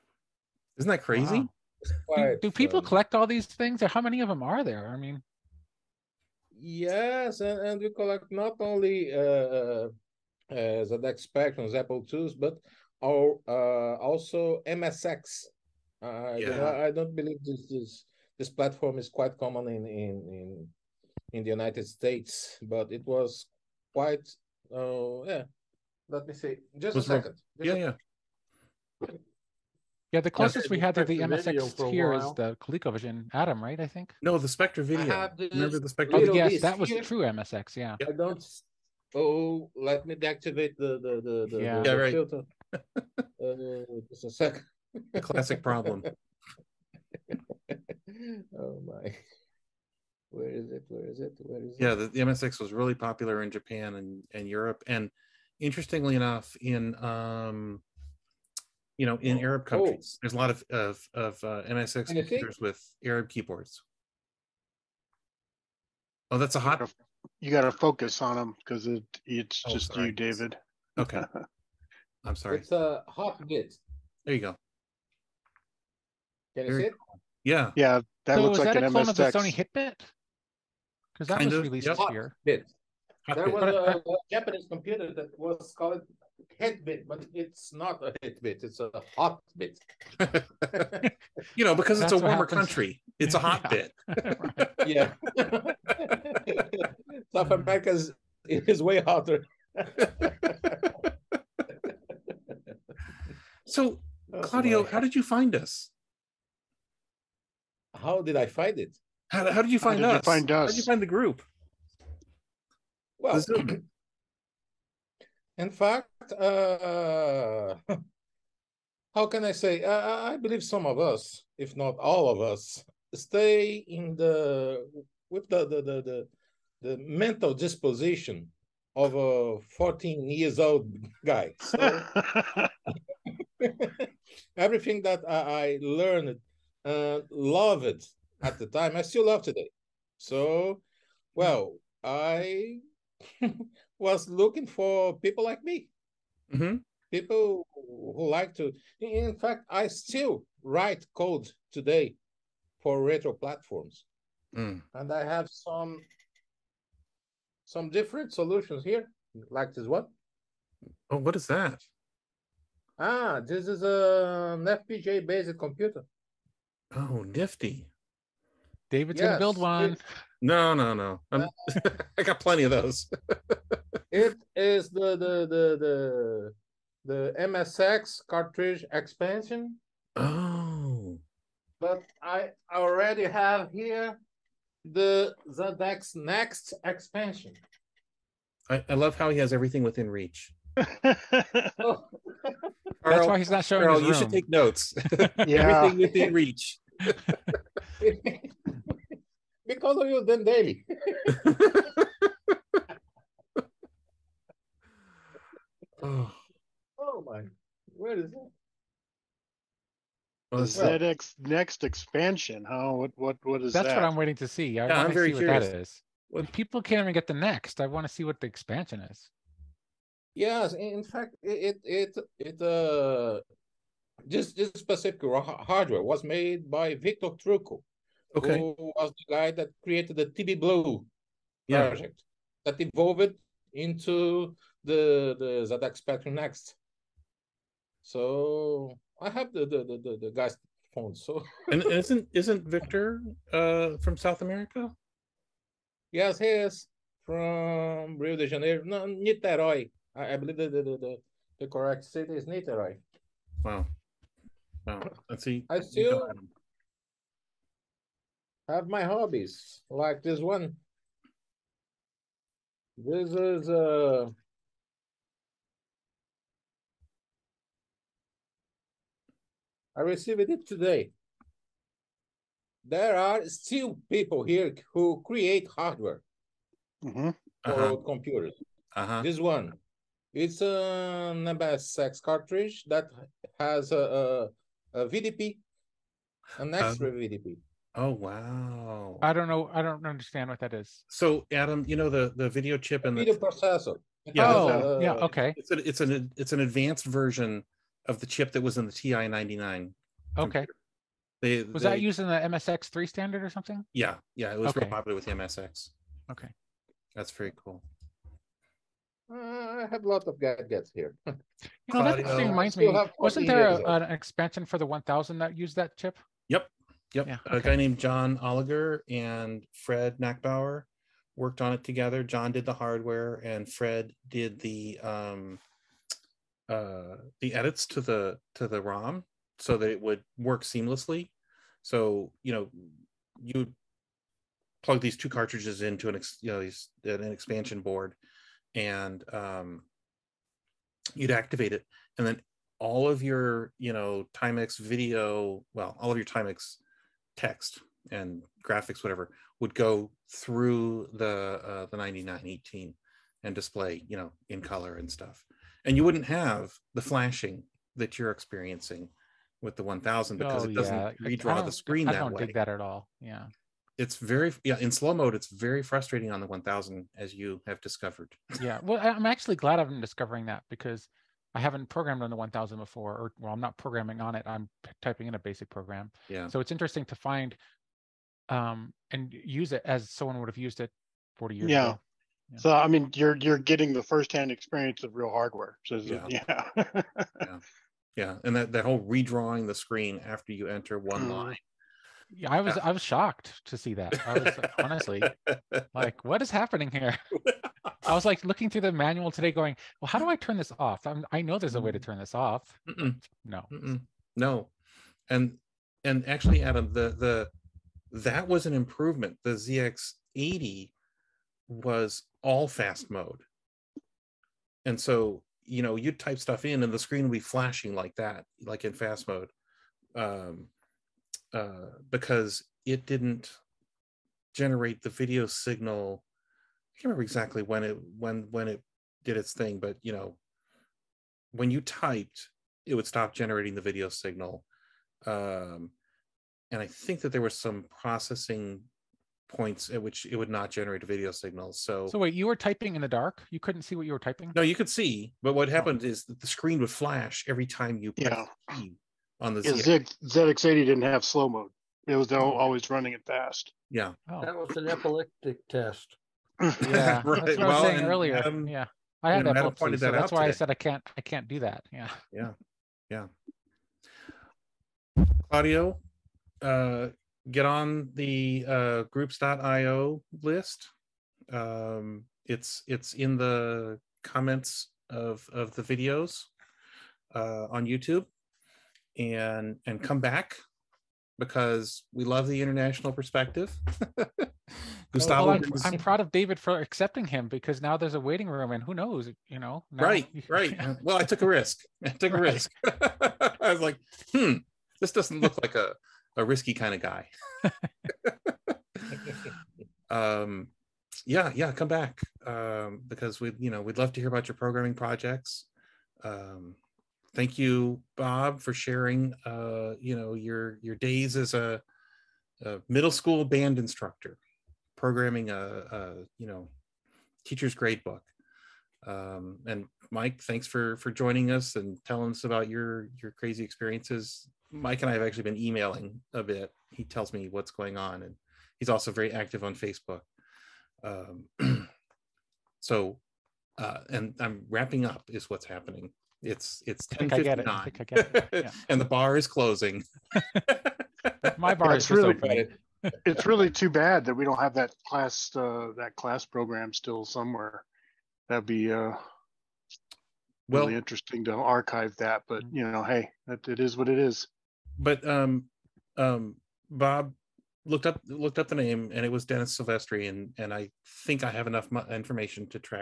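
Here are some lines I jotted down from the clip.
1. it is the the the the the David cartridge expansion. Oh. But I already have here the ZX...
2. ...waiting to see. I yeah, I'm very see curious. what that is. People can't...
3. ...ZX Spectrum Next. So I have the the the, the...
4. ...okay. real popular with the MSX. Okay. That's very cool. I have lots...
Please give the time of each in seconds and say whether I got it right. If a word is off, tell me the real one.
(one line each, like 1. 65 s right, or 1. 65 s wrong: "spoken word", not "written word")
1. 174 s wrong: "MSX", not "David"
2. 214 s right
3. 235 s right
4. 304 s right.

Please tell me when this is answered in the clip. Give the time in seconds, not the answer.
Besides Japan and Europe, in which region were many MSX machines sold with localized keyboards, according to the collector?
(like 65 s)
59 s.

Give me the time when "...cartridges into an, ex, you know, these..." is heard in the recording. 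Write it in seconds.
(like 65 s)
335 s.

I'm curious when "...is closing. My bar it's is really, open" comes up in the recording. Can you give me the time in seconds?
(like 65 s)
539 s.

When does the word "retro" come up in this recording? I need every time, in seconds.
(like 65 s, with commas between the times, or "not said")
153 s.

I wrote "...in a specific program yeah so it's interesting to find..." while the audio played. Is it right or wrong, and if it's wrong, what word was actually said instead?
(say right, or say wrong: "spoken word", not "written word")
wrong: "basic", not "specific".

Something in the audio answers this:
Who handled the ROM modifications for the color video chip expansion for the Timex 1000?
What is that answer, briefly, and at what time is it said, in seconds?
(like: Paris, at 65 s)
Fred Nachbar, at 319 s.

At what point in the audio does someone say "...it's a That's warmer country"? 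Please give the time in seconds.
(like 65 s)
92 s.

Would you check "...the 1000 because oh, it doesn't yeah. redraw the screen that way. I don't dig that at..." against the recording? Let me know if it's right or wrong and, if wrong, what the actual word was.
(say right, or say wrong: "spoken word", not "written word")
right.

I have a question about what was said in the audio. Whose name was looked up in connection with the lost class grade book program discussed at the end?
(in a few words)
Dennis Silvestri.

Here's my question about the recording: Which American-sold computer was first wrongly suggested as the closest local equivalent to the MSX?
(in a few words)
ColecoVision Adam.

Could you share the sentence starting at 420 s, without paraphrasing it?
Um, uh, because it didn't generate the video signal.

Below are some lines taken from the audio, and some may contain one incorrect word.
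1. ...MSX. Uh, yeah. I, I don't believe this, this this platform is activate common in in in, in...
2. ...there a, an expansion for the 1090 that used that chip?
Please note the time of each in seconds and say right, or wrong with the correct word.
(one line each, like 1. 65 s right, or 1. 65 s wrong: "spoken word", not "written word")
1. 14 s wrong: "quite", not "activate"
2. 313 s wrong: "1000", not "1090".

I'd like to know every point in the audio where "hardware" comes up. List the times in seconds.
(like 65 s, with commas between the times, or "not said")
225 s, 275 s, 322 s, 385 s.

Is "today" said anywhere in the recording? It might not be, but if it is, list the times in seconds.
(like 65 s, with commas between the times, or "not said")
139 s, 151 s, 270 s, 399 s, 460 s.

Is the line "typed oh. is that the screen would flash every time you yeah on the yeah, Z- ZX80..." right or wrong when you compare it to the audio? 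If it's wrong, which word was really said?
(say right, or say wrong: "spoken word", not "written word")
wrong: "happened", not "typed".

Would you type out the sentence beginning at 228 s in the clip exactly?
who was the guy that created the TBBlue yeah.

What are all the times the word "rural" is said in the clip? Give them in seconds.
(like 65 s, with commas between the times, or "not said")
not said.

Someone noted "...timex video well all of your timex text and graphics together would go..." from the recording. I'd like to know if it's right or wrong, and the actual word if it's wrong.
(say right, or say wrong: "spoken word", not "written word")
wrong: "whatever", not "together".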